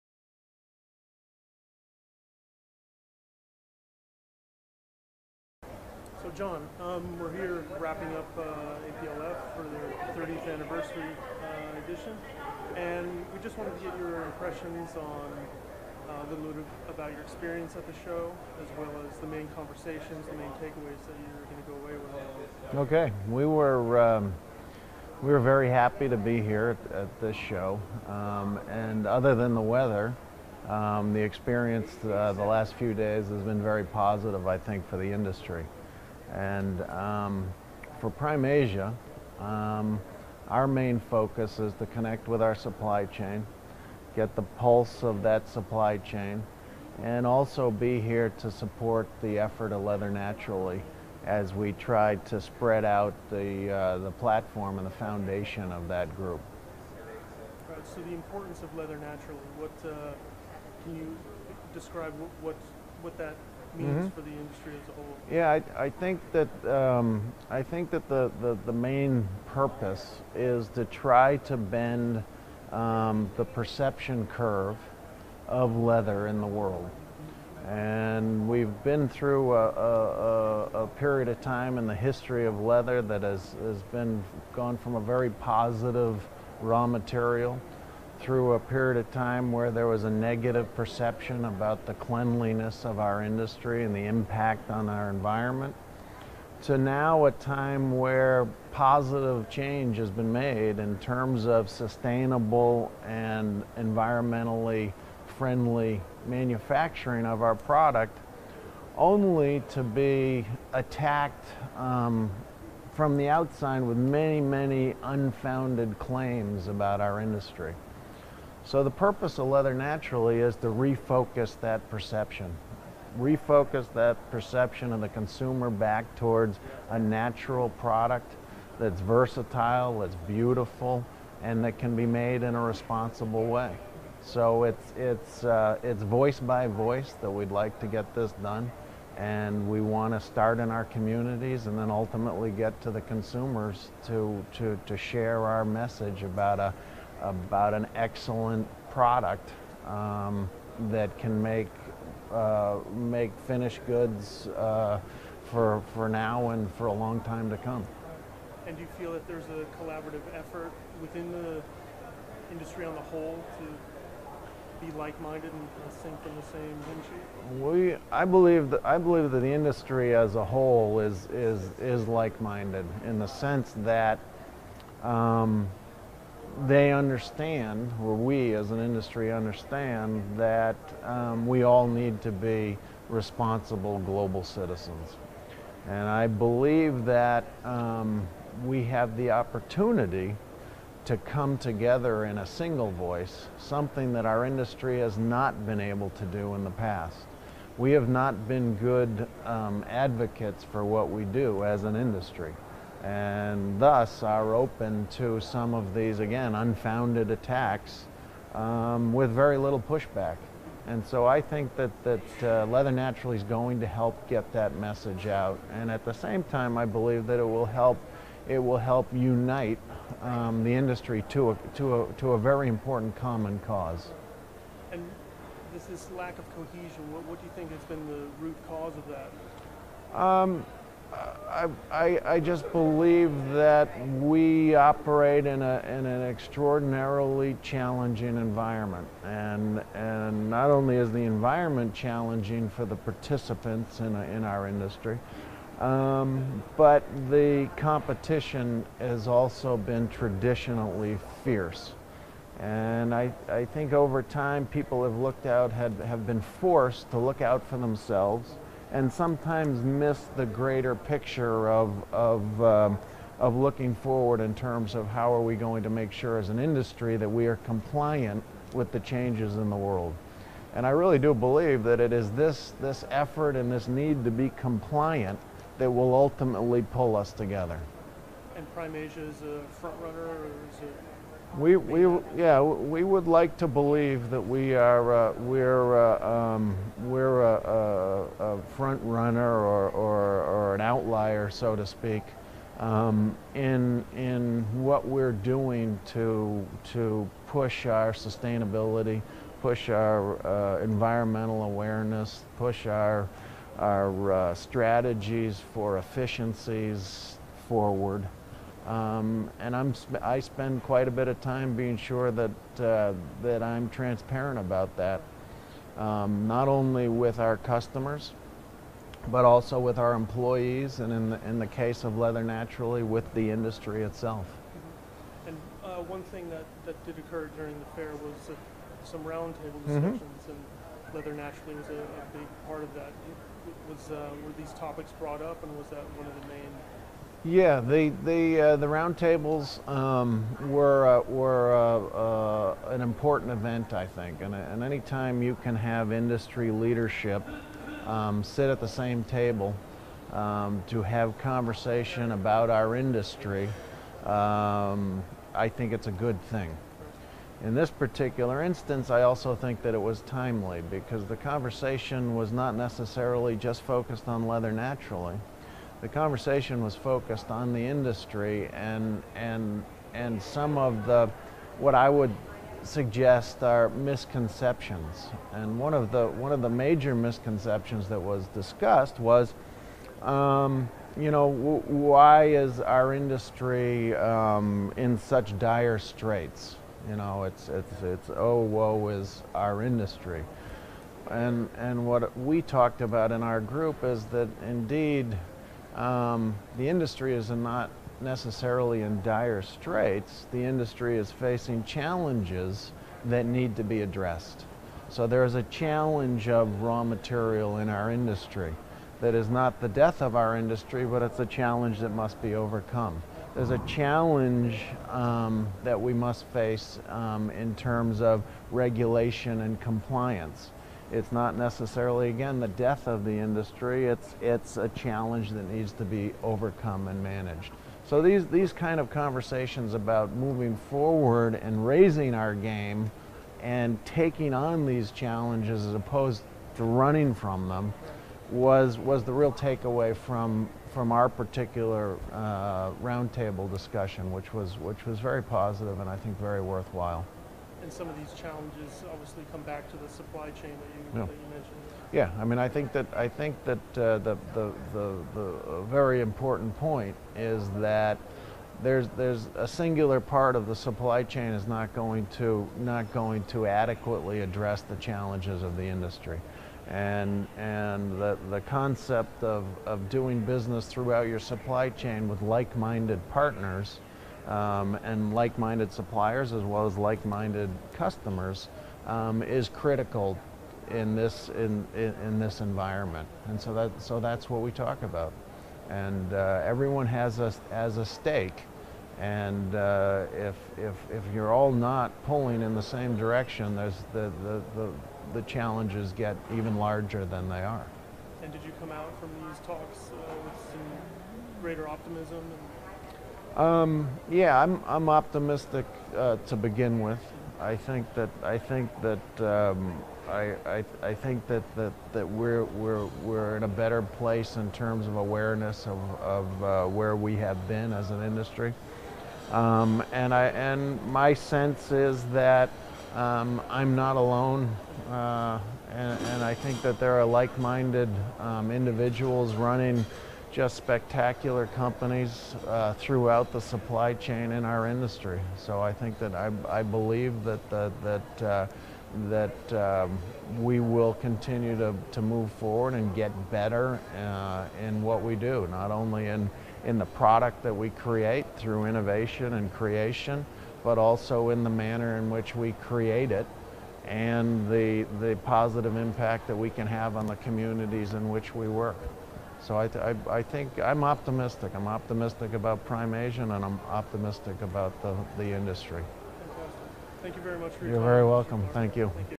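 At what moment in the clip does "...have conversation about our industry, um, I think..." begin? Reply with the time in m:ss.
5:51.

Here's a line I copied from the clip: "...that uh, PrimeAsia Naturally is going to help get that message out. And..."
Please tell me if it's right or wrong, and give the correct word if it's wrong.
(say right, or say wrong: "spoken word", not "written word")
wrong: "Leather", not "PrimeAsia".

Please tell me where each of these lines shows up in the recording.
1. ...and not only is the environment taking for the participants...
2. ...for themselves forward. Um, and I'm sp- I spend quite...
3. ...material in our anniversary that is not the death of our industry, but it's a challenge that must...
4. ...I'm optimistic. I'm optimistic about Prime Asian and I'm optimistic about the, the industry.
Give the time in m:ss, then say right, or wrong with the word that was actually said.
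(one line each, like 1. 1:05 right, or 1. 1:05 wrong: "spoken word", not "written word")
1. 3:59 wrong: "challenging", not "taking"
2. 5:05 wrong: "efficiencies", not "themselves"
3. 6:47 wrong: "industry", not "anniversary"
4. 9:20 right.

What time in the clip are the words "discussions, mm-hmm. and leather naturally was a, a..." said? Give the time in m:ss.
5:29.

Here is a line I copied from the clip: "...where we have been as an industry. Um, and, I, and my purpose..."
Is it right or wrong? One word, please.
wrong.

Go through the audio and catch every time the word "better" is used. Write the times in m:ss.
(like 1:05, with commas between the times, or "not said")
8:33, 9:03.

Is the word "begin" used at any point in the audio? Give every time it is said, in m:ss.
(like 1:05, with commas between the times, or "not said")
8:26.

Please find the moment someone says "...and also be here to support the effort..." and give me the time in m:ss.
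0:47.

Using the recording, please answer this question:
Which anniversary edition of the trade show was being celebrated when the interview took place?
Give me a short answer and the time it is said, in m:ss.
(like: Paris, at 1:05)
30th, at 0:10.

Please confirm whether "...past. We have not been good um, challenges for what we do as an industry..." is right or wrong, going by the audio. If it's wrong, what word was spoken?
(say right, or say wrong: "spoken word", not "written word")
wrong: "advocates", not "challenges".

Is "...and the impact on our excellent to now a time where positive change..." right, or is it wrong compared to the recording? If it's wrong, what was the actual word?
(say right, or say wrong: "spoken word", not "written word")
wrong: "environment", not "excellent".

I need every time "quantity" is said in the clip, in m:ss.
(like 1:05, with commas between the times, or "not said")
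not said.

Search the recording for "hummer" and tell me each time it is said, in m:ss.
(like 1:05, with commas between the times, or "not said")
not said.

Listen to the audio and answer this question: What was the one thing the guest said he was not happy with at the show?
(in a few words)
the weather.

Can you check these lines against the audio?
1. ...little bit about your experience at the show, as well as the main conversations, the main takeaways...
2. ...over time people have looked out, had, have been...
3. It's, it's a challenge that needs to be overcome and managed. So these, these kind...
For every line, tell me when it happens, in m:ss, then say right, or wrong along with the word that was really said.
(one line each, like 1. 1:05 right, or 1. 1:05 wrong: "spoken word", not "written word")
1. 0:16 right
2. 4:13 right
3. 7:04 right.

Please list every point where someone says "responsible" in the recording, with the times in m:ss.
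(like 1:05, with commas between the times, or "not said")
2:12, 3:03.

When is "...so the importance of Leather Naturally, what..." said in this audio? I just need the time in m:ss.
0:57.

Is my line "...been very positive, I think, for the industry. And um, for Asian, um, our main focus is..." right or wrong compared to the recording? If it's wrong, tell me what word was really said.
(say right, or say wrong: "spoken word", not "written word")
wrong: "PrimeAsia", not "Asian".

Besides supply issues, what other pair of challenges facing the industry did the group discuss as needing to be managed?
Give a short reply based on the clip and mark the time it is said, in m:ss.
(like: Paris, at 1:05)
regulation and compliance, at 6:58.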